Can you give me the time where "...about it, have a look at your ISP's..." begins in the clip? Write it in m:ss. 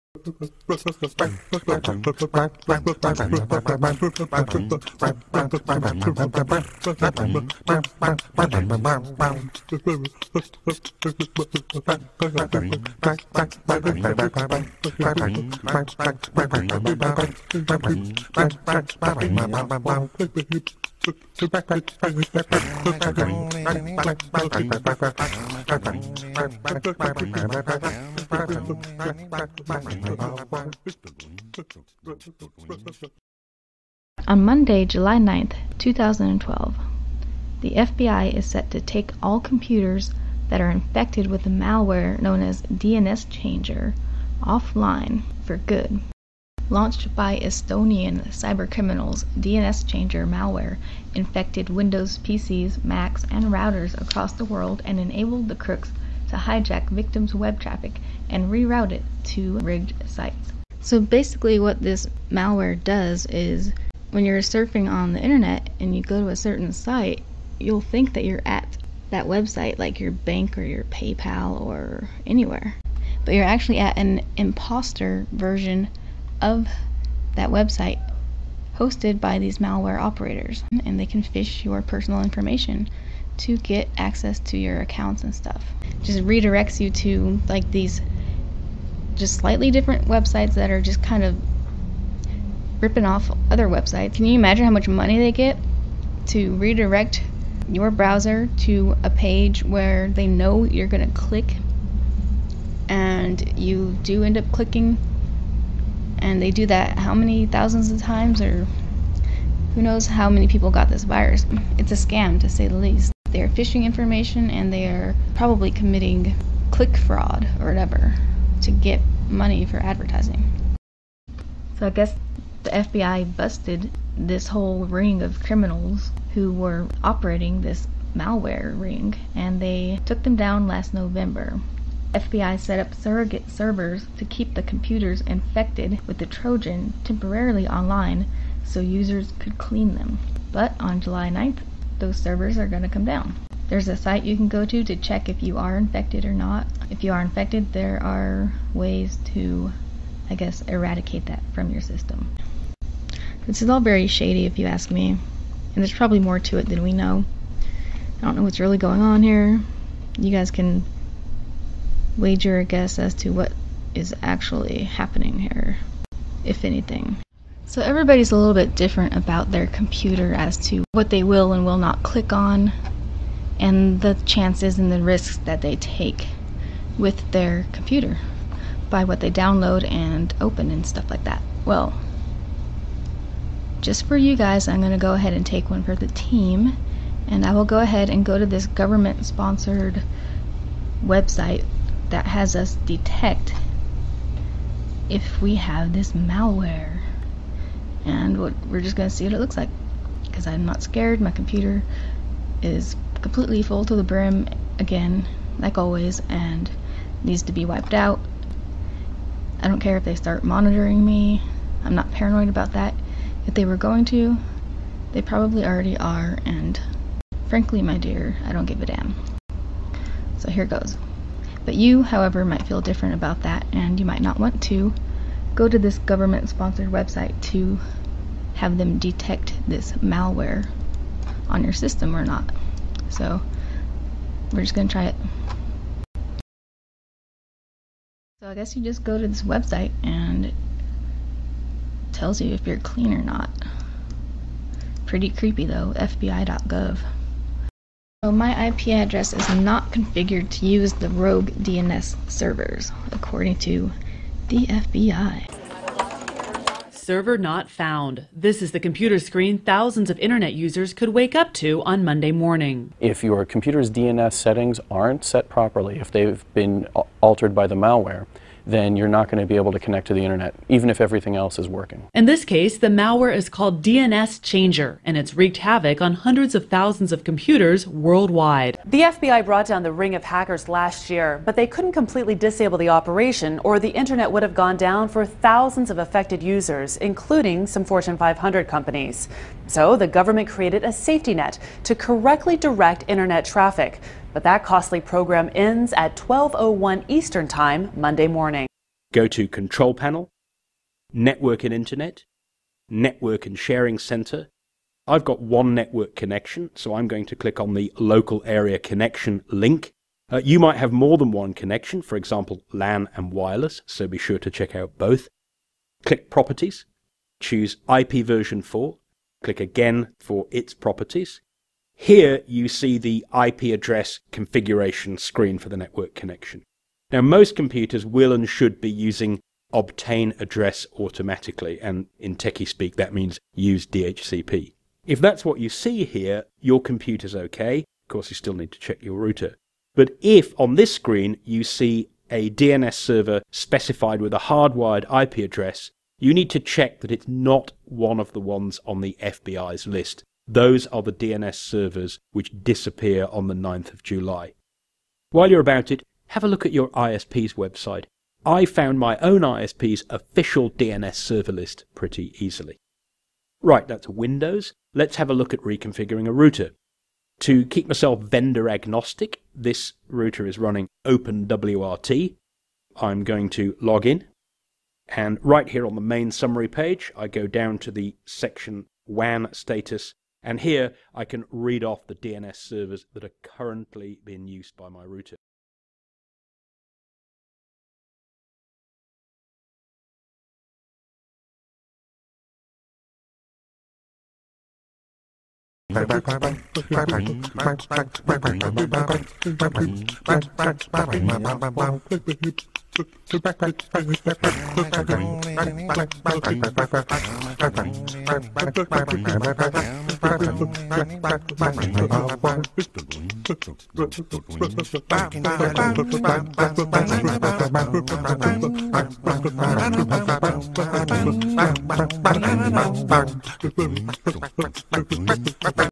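5:55.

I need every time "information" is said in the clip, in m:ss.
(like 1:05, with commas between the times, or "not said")
1:22, 1:53.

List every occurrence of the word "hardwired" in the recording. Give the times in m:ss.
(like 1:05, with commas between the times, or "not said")
5:44.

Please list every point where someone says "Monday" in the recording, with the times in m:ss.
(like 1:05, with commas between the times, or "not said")
0:34, 4:22, 4:57.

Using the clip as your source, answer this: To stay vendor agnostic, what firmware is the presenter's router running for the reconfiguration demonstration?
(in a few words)
OpenWRT.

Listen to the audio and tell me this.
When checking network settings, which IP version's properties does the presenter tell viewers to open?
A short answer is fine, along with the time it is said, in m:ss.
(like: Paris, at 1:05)
IP version 4, at 5:17.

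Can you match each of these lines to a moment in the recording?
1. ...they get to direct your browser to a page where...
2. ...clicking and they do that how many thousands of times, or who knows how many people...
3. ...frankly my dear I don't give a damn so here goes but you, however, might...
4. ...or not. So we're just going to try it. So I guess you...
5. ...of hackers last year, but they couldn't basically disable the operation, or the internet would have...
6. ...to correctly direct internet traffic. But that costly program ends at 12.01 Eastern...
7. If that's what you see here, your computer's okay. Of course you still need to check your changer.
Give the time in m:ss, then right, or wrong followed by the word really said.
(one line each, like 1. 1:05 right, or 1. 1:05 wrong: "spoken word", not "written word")
1. 1:35 wrong: "redirect", not "direct"
2. 1:44 right
3. 3:37 right
4. 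3:52 right
5. 4:40 wrong: "completely", not "basically"
6. 4:51 right
7. 5:35 wrong: "router", not "changer".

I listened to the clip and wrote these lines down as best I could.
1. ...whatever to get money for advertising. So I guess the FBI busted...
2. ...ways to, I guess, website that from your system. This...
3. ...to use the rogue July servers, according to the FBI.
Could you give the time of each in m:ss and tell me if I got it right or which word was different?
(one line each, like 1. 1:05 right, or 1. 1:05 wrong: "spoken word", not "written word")
1. 1:57 right
2. 2:28 wrong: "eradicate", not "website"
3. 4:10 wrong: "DNS", not "July".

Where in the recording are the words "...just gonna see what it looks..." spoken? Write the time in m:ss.
3:18.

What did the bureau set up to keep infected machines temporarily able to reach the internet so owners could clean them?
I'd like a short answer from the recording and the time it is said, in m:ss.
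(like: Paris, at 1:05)
surrogate servers, at 2:12.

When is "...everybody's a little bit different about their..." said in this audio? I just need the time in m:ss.
2:47.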